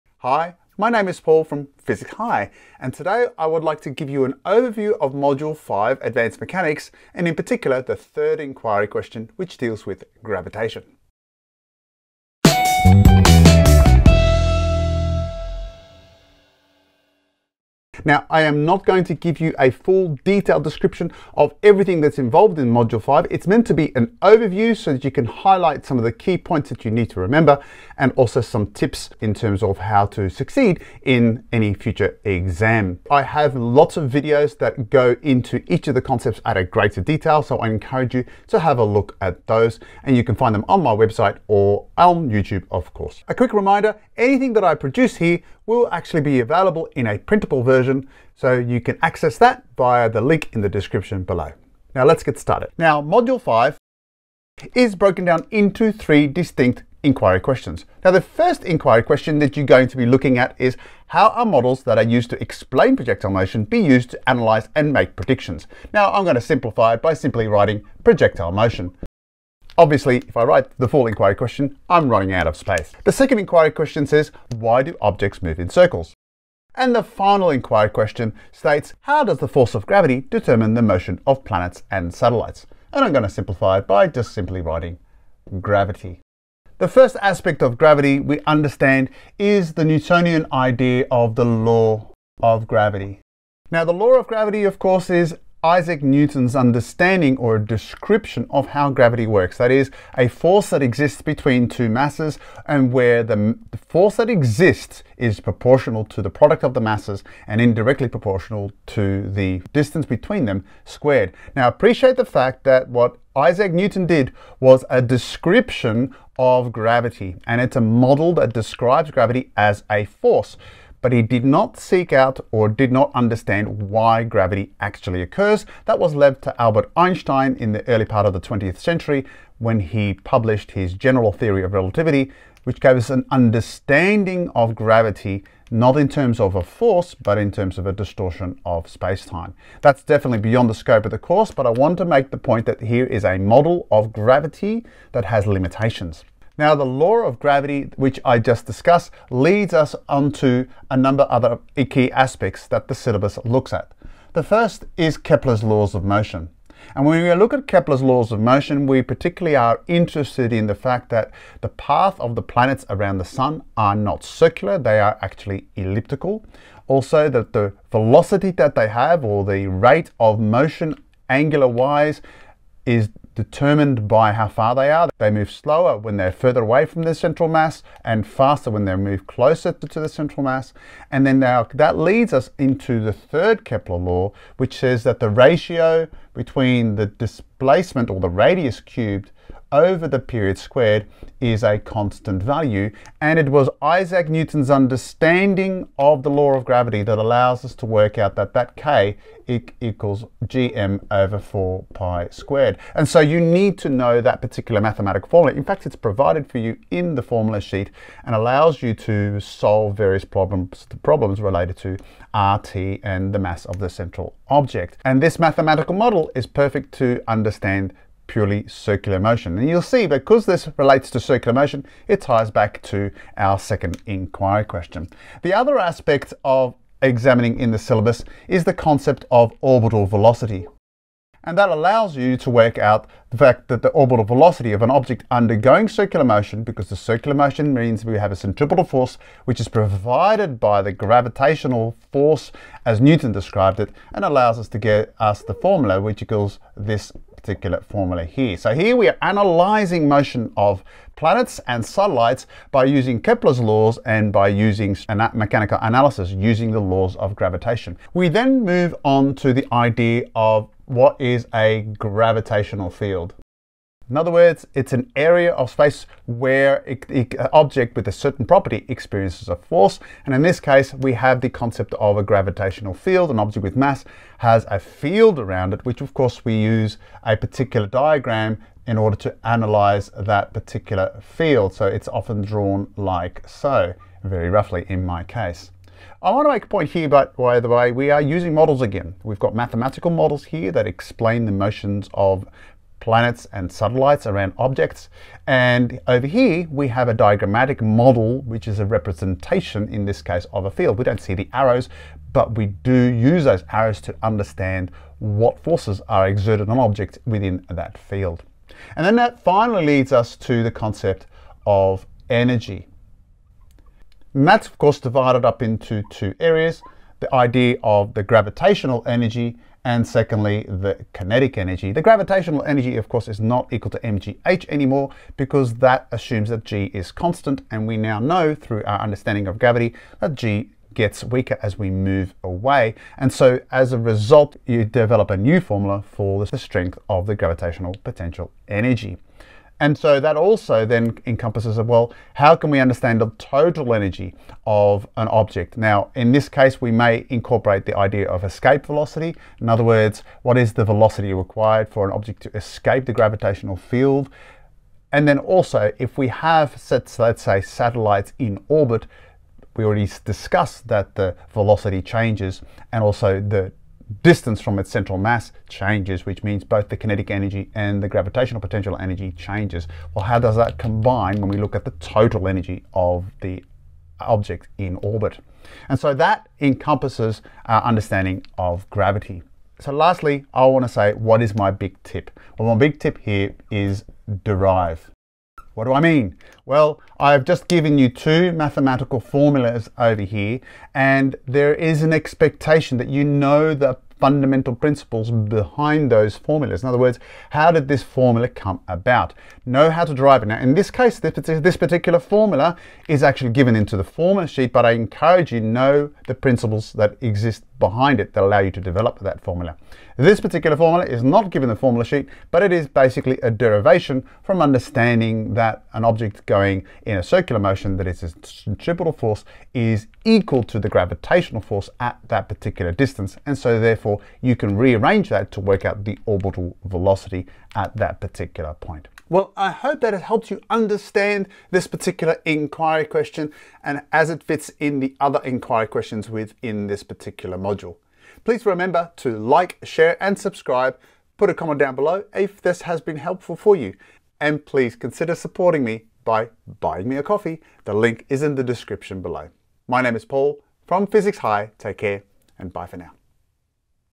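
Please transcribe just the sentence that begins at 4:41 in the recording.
So it's often drawn like so, very roughly in my case.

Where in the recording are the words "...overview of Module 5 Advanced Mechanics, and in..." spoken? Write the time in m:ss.
0:04.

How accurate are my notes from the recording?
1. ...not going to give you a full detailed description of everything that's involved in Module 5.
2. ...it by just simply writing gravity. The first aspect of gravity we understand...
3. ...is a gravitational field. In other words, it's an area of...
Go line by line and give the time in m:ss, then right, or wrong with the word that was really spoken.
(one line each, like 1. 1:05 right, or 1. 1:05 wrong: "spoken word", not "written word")
1. 0:18 right
2. 1:23 right
3. 4:21 right.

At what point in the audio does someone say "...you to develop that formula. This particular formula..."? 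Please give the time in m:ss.
6:48.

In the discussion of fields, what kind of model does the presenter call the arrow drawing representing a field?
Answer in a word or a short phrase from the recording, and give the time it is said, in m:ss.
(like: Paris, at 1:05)
Diagrammatic model, at 4:57.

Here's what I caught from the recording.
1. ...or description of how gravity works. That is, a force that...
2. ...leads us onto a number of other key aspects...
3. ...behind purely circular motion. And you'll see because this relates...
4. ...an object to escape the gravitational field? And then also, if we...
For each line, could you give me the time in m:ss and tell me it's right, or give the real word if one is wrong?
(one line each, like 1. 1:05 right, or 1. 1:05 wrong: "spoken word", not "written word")
1. 1:37 right
2. 2:29 right
3. 3:37 wrong: "understand", not "behind"
4. 5:52 right.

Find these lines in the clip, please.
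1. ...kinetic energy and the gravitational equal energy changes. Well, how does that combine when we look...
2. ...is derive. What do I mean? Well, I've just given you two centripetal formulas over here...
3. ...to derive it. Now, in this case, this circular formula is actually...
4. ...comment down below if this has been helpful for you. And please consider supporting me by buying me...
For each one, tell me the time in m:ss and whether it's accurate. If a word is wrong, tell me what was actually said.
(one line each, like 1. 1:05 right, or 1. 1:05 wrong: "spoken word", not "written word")
1. 6:06 wrong: "potential", not "equal"
2. 6:23 wrong: "mathematical", not "centripetal"
3. 6:40 wrong: "particular", not "circular"
4. 7:21 right.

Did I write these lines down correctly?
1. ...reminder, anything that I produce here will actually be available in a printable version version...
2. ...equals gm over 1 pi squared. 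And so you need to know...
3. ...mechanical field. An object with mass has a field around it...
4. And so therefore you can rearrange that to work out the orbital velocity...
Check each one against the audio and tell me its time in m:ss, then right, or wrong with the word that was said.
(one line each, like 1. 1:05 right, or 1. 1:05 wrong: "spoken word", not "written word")
1. 0:43 right
2. 3:19 wrong: "4", not "1"
3. 4:32 wrong: "gravitational", not "mechanical"
4. 7:03 right.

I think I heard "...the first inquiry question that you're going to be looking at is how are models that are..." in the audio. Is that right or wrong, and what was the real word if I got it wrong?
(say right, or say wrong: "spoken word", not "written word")
right.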